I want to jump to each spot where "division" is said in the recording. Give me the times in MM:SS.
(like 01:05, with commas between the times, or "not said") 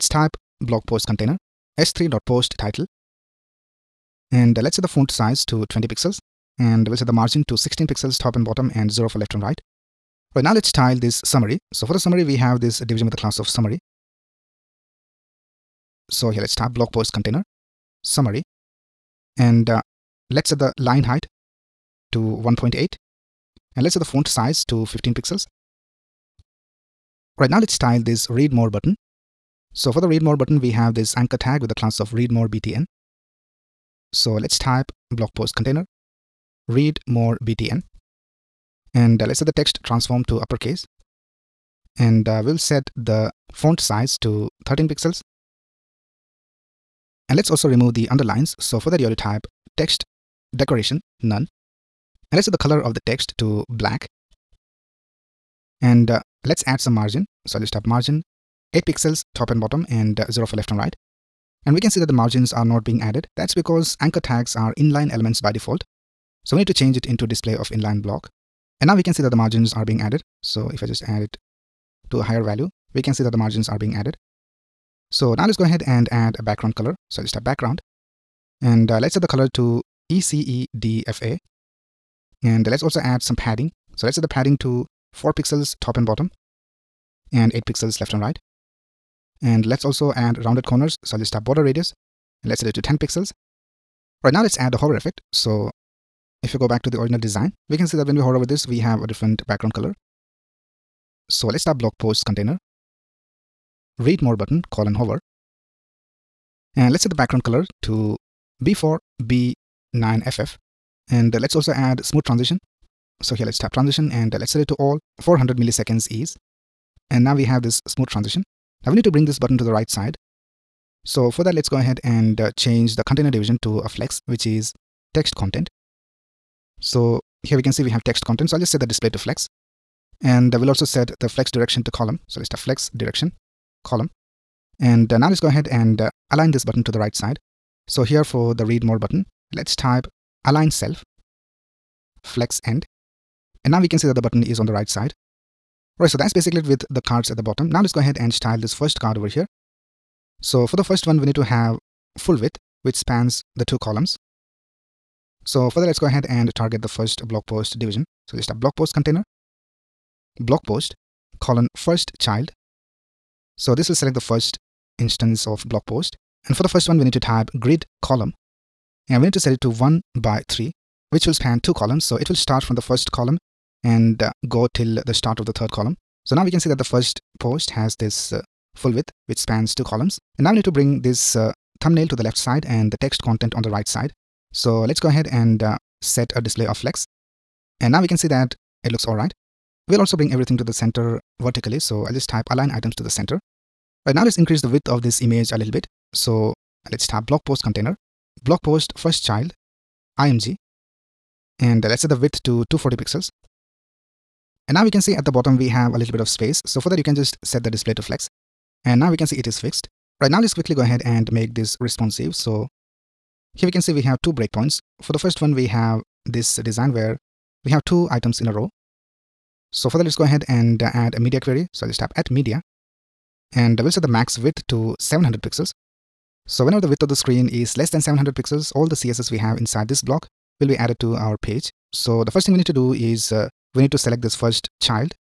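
00:12, 02:03, 02:37.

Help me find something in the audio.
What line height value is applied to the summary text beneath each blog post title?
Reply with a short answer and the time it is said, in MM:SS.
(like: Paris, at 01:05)
1.8, at 00:22.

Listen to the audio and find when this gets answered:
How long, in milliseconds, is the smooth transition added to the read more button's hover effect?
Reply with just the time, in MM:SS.
01:55.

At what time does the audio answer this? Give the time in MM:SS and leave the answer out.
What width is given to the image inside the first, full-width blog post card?
03:22.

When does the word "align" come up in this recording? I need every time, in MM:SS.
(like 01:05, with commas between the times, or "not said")
02:16, 02:20, 03:12.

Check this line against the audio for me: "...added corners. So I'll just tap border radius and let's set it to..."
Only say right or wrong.
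wrong.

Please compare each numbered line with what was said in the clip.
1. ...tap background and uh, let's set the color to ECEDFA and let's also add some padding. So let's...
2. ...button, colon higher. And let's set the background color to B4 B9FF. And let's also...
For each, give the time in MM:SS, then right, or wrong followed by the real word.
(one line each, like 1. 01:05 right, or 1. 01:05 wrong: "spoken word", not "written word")
1. 01:17 right
2. 01:44 wrong: "hover", not "higher".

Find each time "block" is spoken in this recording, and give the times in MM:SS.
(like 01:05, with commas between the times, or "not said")
01:08, 03:50.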